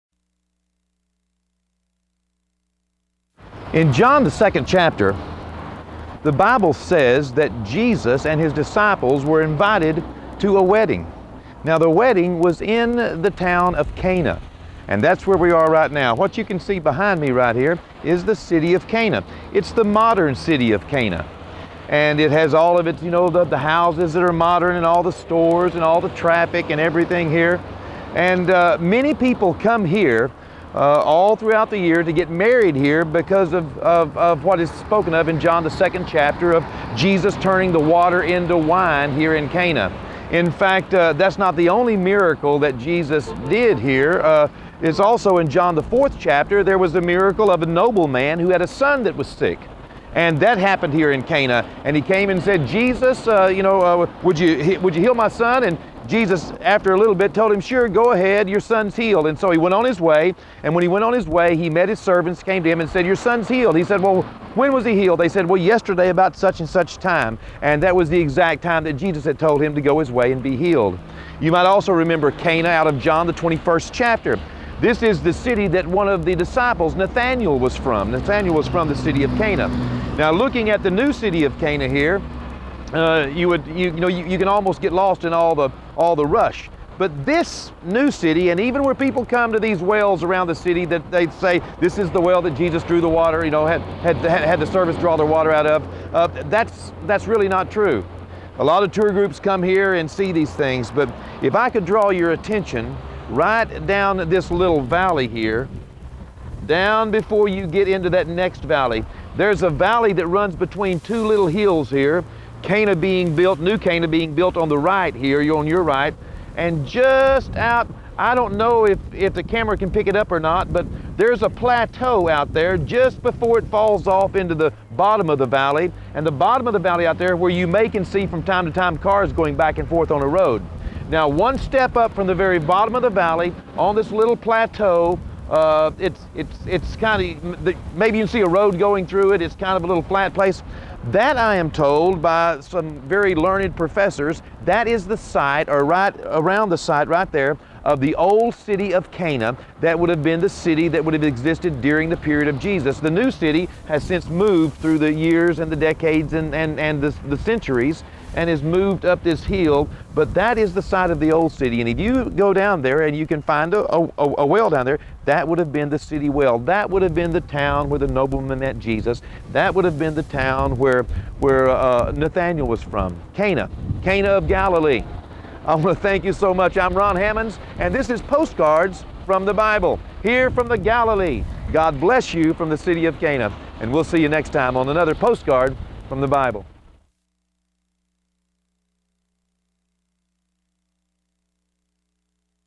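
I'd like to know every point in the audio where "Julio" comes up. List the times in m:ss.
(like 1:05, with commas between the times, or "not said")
not said.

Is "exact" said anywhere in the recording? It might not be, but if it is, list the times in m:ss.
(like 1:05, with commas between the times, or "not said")
1:08.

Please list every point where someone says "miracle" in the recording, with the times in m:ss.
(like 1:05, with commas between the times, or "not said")
0:41, 0:47.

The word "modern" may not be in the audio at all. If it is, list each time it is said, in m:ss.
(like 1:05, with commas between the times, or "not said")
0:19, 0:24.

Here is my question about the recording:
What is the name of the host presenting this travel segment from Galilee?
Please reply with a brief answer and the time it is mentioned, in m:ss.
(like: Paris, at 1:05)
Ron Hammonds, at 2:56.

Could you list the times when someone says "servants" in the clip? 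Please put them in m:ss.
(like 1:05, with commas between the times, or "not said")
1:01, 1:34.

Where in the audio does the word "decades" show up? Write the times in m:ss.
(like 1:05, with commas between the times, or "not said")
2:35.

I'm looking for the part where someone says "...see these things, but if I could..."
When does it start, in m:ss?
1:40.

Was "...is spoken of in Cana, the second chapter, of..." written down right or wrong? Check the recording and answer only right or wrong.
wrong.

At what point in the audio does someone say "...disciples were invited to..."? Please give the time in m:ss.
0:08.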